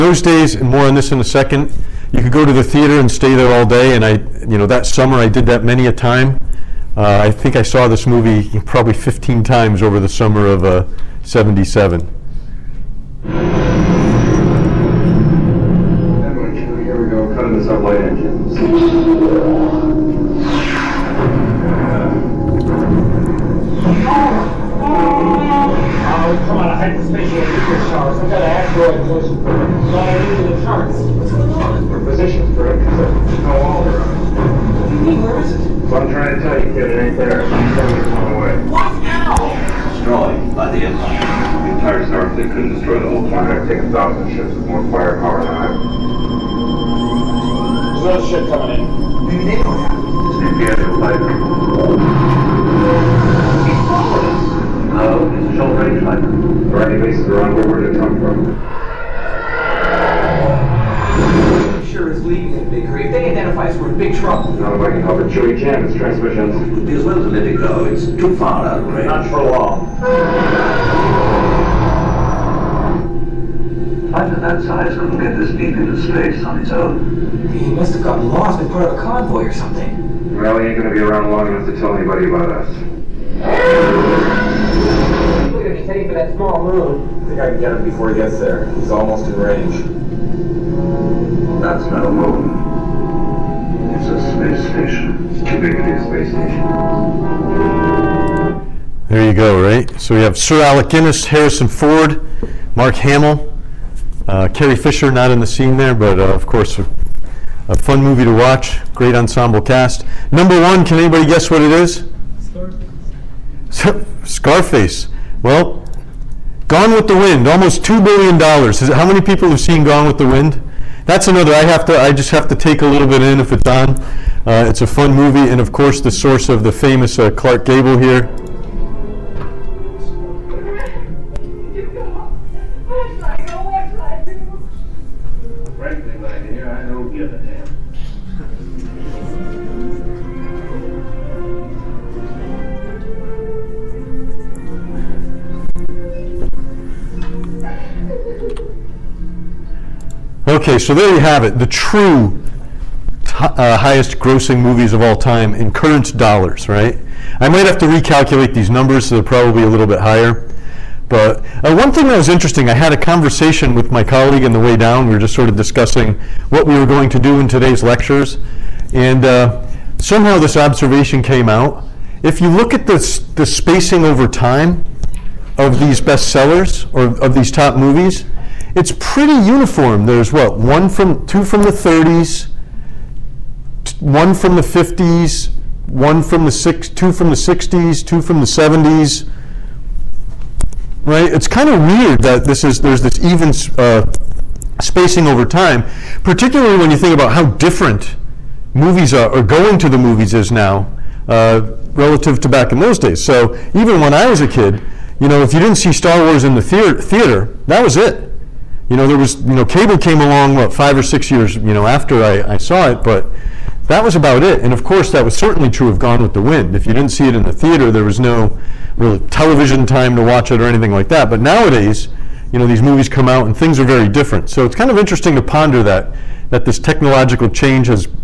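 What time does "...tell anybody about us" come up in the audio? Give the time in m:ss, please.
1:21.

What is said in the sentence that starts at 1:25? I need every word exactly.
We're gonna be heading for that small moon.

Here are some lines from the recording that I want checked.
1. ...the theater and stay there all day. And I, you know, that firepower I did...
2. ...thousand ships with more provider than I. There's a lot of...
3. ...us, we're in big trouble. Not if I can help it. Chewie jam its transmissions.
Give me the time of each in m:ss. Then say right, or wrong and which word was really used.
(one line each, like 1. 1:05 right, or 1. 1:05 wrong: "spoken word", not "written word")
1. 0:02 wrong: "summer", not "firepower"
2. 0:43 wrong: "firepower", not "provider"
3. 1:03 right.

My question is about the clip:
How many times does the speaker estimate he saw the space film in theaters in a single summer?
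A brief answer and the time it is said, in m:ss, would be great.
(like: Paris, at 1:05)
15, at 0:08.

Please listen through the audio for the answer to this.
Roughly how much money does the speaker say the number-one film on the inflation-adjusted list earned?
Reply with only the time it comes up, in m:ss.
1:57.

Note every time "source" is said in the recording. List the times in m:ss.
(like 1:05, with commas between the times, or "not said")
2:06.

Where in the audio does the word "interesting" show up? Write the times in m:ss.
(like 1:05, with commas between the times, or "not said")
2:42, 3:44.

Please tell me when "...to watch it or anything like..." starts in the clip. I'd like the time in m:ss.
3:40.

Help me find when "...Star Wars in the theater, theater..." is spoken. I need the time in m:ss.
3:25.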